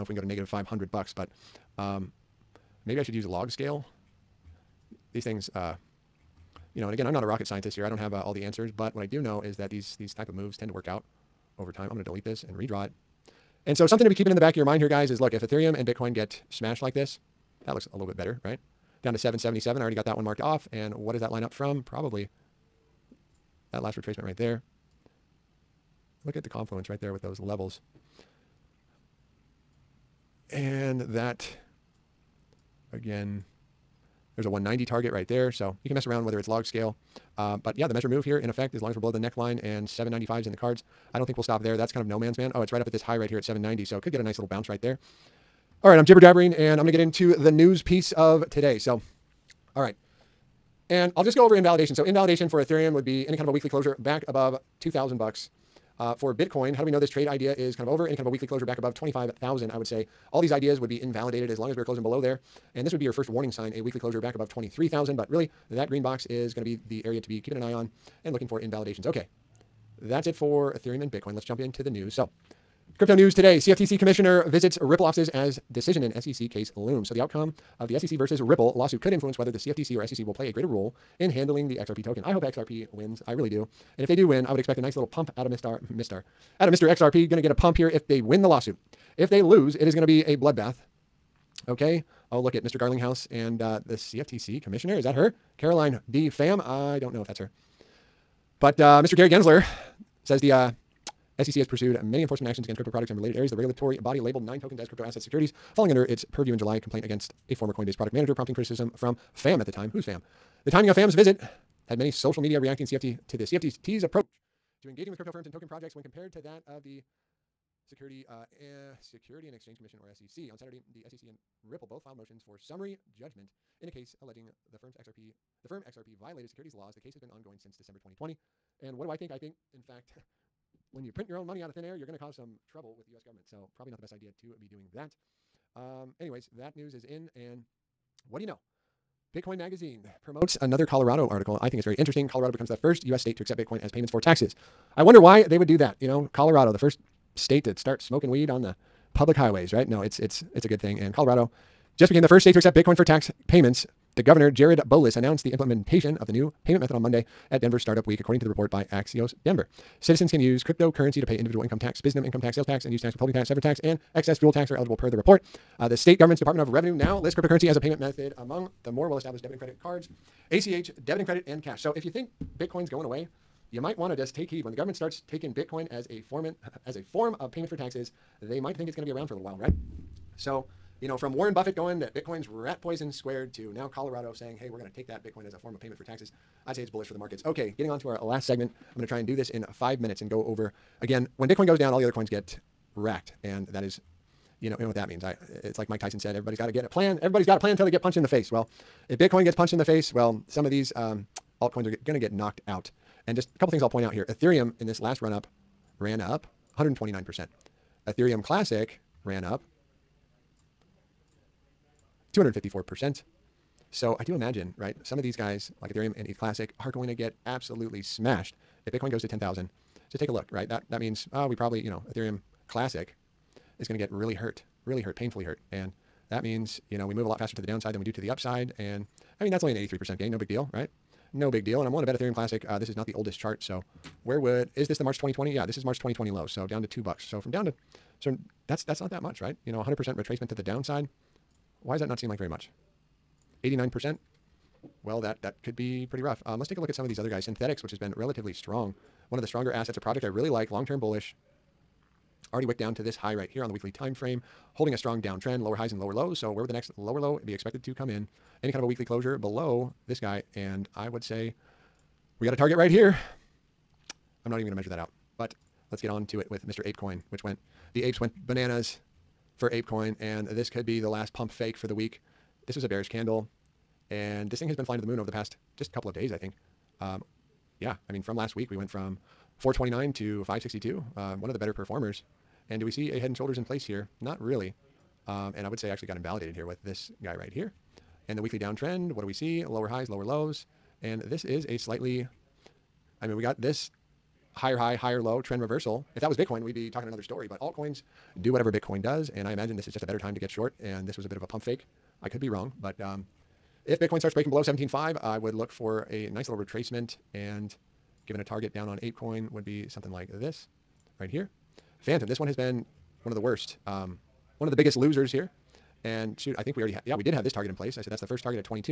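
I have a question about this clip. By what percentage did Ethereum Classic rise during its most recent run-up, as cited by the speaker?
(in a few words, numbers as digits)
254%.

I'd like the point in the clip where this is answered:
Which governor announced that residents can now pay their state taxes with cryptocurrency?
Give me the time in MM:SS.
02:34.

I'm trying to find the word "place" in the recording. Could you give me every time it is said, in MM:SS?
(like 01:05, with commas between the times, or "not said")
04:43, 05:17.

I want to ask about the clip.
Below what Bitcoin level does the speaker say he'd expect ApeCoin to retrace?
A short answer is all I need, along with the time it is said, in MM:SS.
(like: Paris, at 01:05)
17.5, at 05:04.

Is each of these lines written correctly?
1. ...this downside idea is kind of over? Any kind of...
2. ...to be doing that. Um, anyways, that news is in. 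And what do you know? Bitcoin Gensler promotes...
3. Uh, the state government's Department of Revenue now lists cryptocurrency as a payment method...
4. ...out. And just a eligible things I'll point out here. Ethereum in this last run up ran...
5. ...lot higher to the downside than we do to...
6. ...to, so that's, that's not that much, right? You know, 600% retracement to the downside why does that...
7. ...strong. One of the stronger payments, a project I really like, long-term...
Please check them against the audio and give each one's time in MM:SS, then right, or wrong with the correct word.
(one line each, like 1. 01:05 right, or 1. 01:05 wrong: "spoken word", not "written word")
1. 00:56 wrong: "trade", not "downside"
2. 02:14 wrong: "Magazine", not "Gensler"
3. 02:45 right
4. 03:22 wrong: "couple", not "eligible"
5. 03:47 wrong: "faster", not "higher"
6. 03:57 wrong: "100", not "600"
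7. 04:08 wrong: "assets", not "payments".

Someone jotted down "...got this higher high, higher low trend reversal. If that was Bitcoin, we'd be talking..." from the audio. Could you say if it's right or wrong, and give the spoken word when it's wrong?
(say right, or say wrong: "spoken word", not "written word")
right.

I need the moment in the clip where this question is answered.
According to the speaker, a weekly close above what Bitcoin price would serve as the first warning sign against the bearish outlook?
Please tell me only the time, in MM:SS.
01:04.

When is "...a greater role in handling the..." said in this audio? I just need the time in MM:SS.
01:20.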